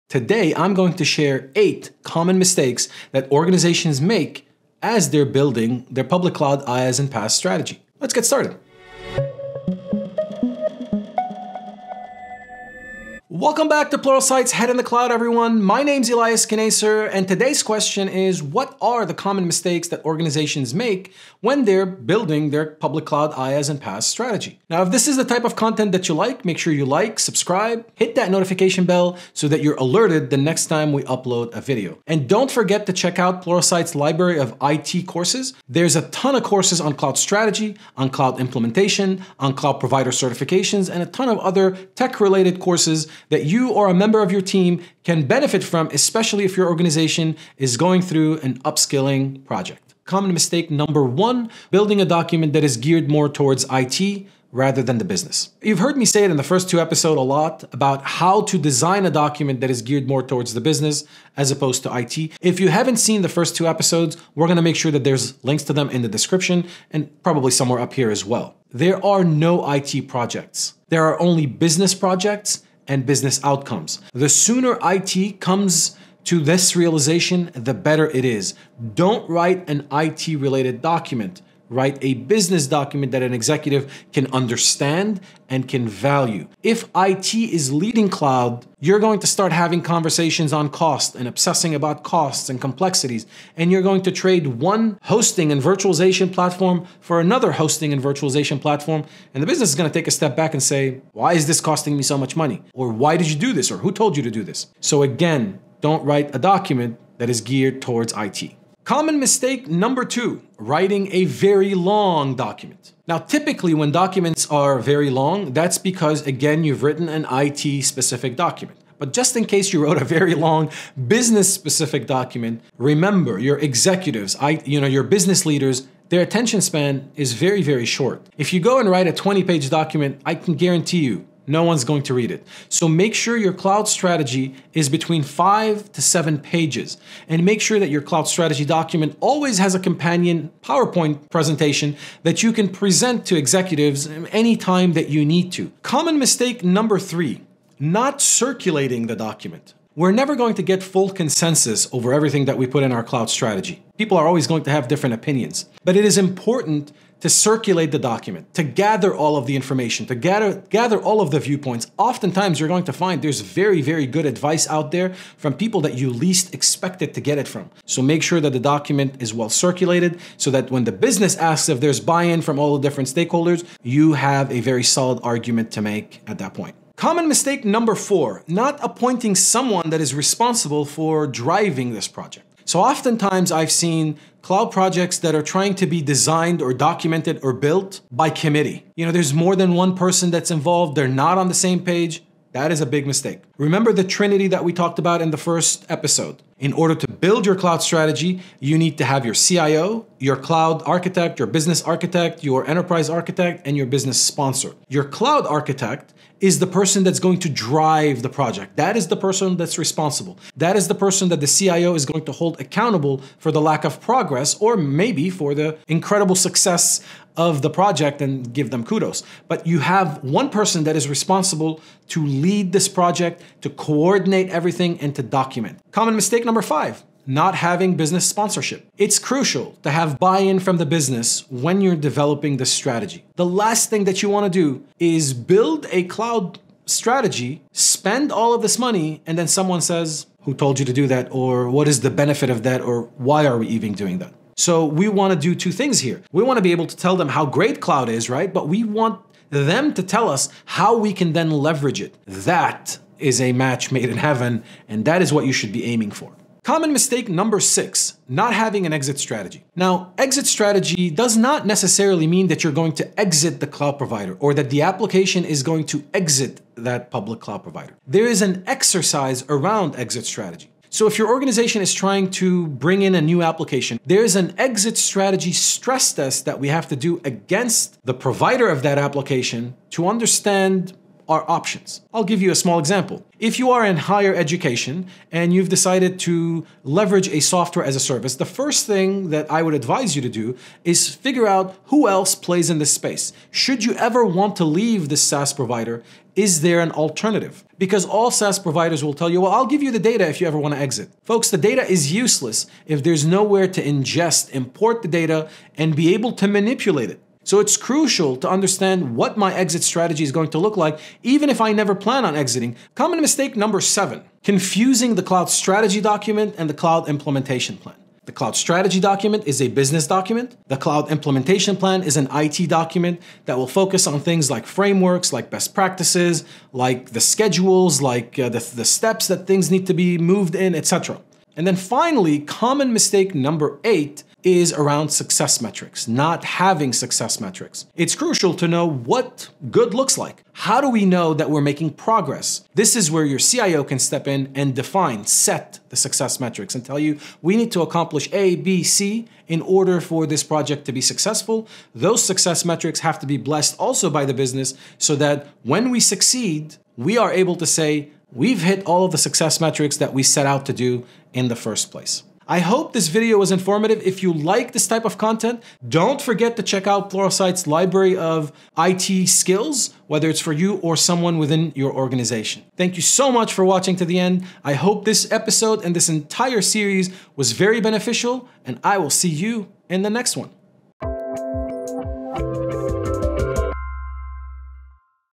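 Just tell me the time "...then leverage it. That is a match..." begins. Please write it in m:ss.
4:11.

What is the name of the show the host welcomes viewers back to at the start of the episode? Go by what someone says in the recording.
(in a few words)
Head in the Cloud.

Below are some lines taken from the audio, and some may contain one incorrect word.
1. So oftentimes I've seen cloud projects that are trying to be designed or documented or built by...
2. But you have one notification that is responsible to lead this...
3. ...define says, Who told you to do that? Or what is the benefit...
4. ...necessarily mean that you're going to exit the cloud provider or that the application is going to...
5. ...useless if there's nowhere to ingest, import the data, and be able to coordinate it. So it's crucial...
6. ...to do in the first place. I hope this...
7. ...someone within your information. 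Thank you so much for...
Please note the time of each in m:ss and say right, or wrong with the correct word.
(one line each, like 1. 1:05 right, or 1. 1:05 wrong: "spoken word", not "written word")
1. 3:02 right
2. 3:39 wrong: "person", not "notification"
3. 3:59 wrong: "someone", not "define"
4. 4:21 right
5. 5:02 wrong: "manipulate", not "coordinate"
6. 6:00 right
7. 6:10 wrong: "organization", not "information".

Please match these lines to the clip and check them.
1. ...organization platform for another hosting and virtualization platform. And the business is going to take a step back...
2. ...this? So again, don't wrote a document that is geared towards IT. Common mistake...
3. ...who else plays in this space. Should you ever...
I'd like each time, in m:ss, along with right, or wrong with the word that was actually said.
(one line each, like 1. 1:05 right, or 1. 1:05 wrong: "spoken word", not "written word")
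1. 1:35 wrong: "virtualization", not "organization"
2. 1:44 wrong: "write", not "wrote"
3. 4:51 right.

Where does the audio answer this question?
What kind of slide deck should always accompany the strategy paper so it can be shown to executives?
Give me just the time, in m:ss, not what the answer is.
2:20.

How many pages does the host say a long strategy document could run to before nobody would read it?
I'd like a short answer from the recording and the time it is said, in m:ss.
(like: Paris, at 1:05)
20, at 2:09.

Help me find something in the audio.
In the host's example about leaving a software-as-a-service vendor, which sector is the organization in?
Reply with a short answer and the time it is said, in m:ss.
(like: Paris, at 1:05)
higher education, at 4:43.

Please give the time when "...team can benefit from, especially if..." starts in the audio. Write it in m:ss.
0:44.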